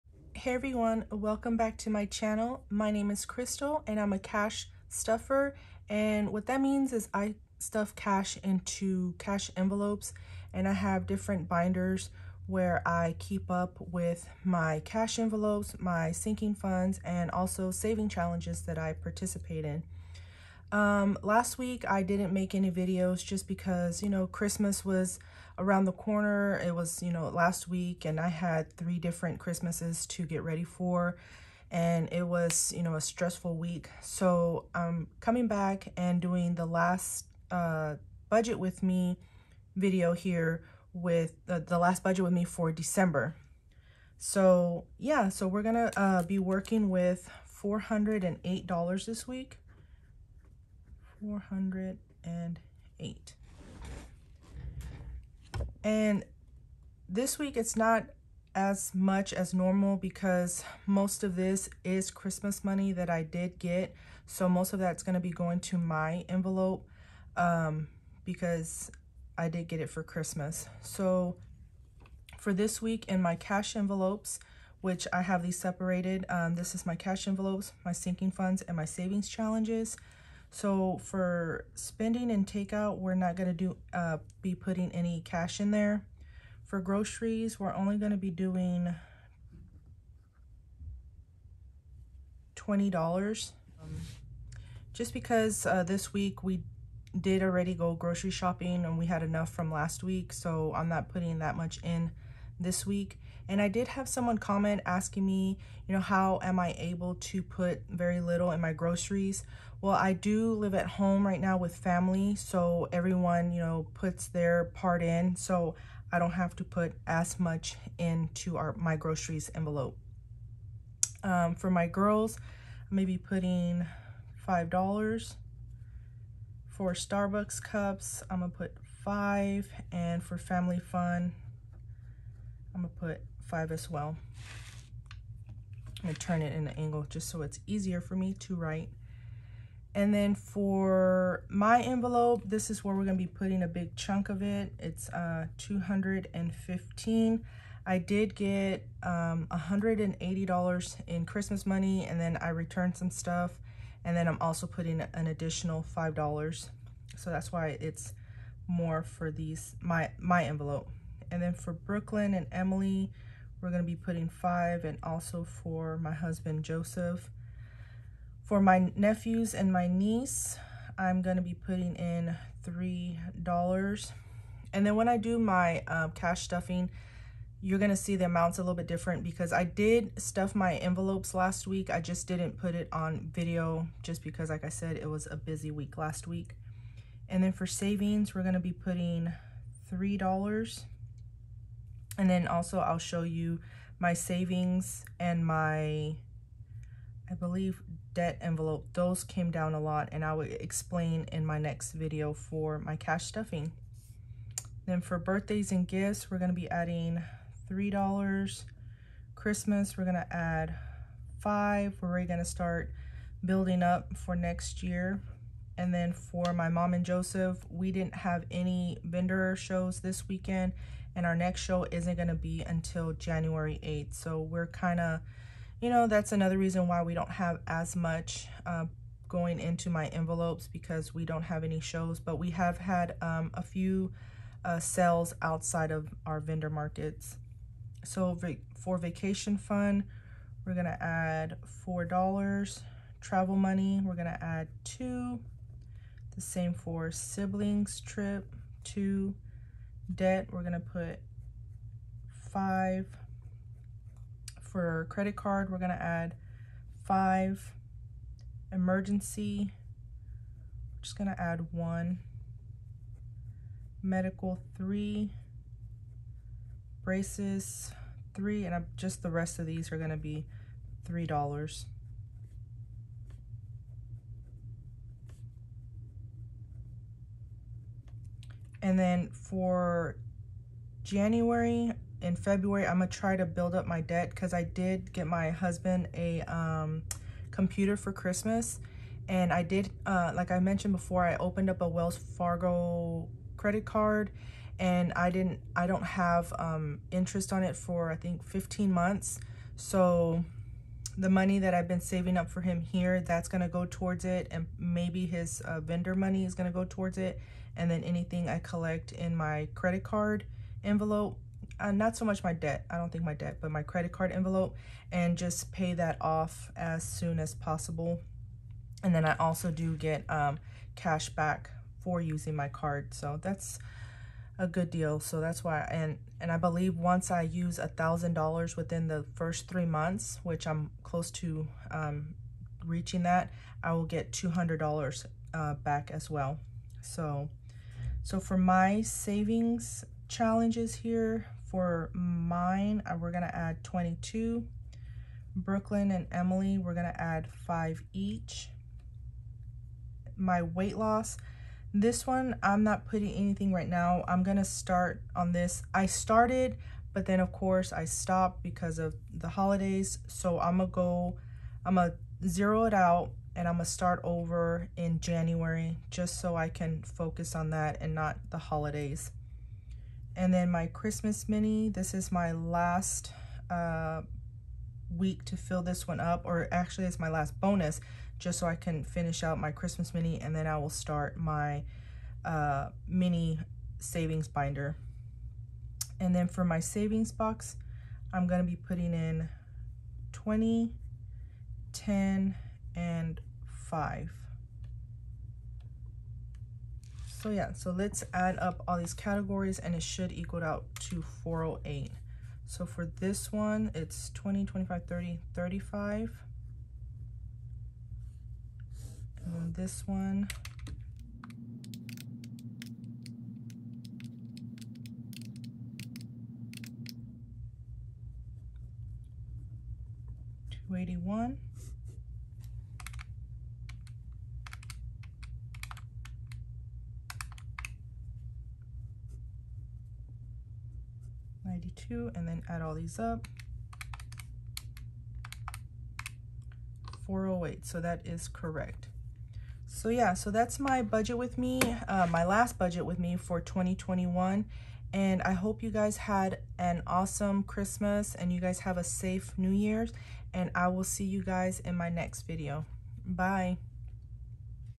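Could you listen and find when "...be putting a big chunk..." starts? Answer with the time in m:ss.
2:23.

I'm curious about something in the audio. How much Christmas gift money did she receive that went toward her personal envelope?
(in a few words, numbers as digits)
$180.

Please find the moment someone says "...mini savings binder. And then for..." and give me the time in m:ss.
6:23.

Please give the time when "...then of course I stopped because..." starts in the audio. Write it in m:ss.
5:57.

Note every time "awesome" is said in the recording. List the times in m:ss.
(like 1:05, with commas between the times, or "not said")
7:27.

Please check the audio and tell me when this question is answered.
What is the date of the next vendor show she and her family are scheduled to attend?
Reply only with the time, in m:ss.
3:43.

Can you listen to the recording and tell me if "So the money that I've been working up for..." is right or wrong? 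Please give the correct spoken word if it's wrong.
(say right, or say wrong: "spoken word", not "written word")
wrong: "saving", not "working".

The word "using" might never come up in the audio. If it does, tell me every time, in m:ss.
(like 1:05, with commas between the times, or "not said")
5:22.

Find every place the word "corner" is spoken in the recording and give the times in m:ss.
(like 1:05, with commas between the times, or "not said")
0:25.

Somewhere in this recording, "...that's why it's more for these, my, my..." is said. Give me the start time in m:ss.
2:37.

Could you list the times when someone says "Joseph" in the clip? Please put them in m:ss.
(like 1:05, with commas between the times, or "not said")
2:46, 3:37.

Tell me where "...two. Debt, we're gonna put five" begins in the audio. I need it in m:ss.
4:08.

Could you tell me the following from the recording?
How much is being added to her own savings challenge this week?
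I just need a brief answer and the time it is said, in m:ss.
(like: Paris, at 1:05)
22, at 5:43.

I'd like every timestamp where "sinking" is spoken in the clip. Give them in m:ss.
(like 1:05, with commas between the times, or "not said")
0:16, 1:17.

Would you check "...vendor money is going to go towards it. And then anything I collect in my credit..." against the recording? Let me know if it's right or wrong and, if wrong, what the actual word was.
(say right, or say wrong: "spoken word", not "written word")
right.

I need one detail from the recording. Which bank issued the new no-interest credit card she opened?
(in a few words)
Wells Fargo.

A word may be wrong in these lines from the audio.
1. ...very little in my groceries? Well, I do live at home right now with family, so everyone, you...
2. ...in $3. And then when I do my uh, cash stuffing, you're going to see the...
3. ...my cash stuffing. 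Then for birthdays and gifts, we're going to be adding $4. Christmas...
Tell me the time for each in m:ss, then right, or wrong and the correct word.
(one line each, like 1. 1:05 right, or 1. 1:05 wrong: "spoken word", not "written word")
1. 1:47 right
2. 2:51 right
3. 3:22 wrong: "3", not "4".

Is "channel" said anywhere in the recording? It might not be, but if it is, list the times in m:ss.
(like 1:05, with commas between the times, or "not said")
0:02.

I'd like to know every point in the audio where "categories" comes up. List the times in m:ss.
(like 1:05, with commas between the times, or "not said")
6:39.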